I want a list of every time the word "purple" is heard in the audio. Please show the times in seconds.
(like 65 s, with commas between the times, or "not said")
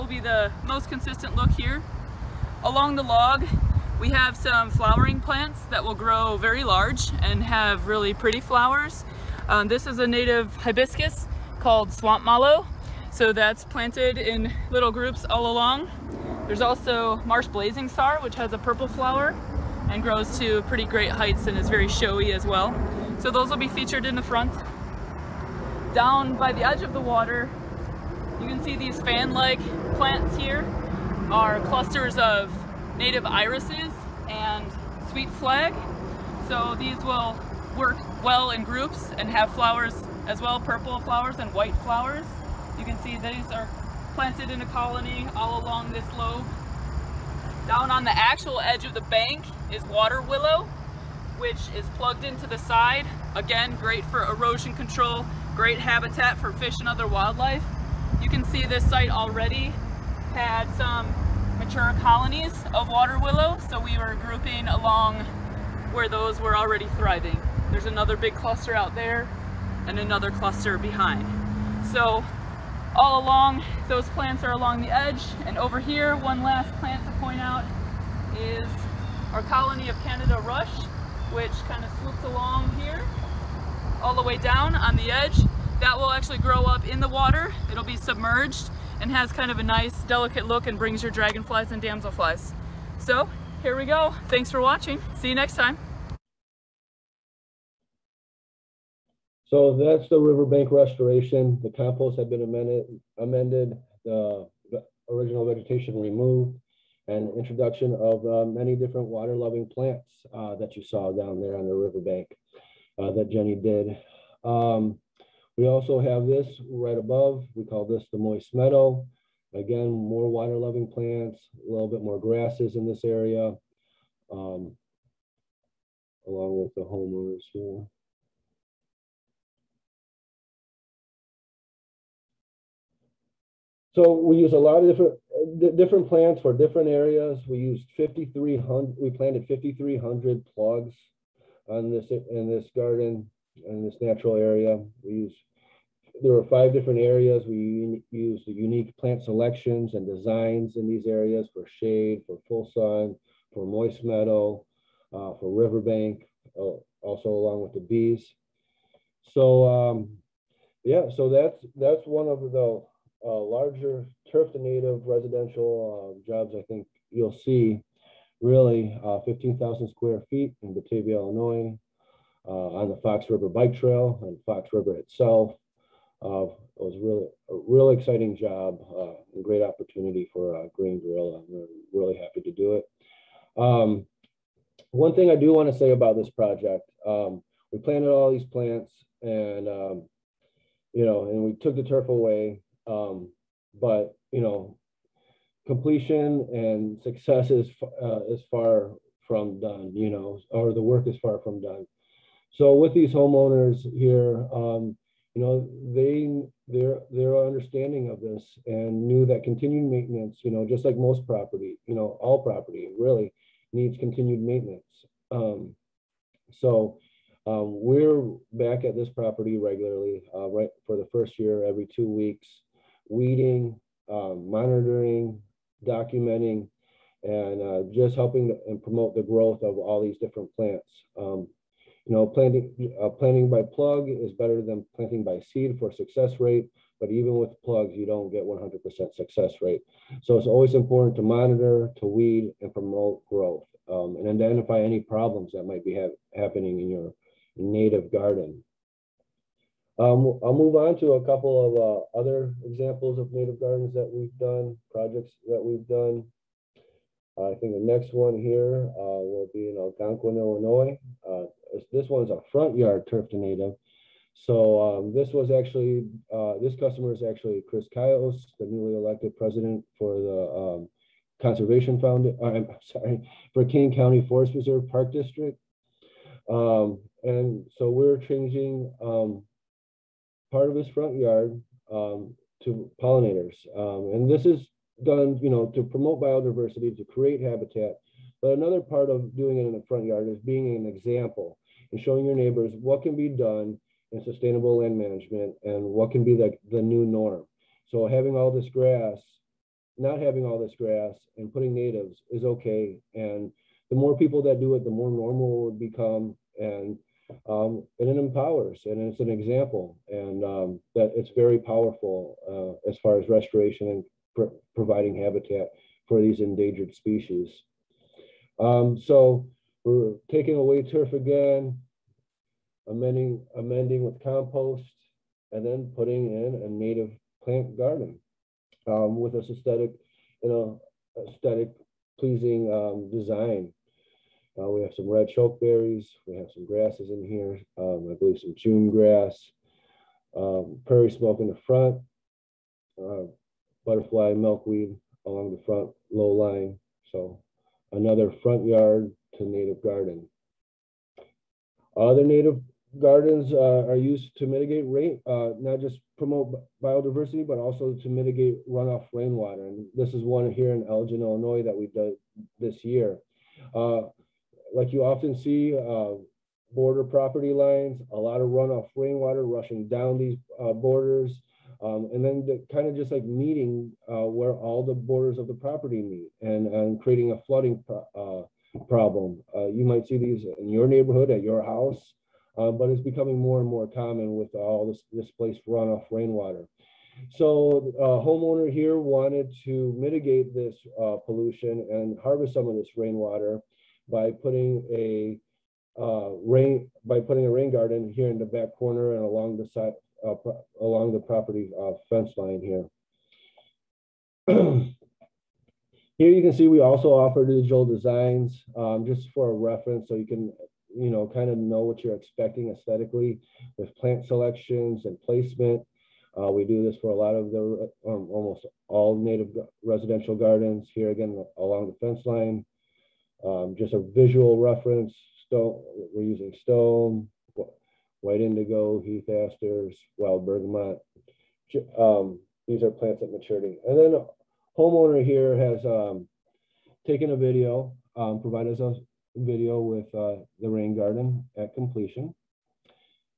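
18 s, 40 s.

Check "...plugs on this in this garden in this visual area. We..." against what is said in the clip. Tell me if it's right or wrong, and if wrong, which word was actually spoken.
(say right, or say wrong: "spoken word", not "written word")
wrong: "natural", not "visual".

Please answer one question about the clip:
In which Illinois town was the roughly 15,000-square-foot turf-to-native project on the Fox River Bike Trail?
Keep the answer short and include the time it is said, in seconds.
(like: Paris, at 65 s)
Batavia, at 170 s.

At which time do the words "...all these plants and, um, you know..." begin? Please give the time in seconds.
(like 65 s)
188 s.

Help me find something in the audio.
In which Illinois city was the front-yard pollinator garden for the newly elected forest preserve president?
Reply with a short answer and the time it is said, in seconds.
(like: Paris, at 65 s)
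Algonquin, at 259 s.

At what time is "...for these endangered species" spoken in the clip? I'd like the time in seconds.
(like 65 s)
316 s.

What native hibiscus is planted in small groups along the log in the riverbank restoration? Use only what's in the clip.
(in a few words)
Swamp mallow.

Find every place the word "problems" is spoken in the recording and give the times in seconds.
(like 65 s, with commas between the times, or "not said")
245 s, 378 s.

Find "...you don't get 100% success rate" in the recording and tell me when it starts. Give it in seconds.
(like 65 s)
237 s.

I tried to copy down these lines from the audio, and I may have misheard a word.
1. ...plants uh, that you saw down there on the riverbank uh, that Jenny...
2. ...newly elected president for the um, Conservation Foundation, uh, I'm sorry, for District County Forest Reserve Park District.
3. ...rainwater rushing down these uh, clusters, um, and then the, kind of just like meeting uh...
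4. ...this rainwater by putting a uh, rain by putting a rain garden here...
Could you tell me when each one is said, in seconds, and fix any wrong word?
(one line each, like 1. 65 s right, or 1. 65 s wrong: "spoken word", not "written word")
1. 109 s right
2. 268 s wrong: "Kane", not "District"
3. 368 s wrong: "borders", not "clusters"
4. 392 s right.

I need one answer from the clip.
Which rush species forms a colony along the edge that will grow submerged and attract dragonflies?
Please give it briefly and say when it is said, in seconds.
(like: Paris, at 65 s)
Canada rush, at 80 s.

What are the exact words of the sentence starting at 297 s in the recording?
So having all this grass, not having all this grass and putting natives is okay.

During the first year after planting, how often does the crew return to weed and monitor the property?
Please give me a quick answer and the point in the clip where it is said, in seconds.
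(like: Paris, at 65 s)
Every two weeks, at 221 s.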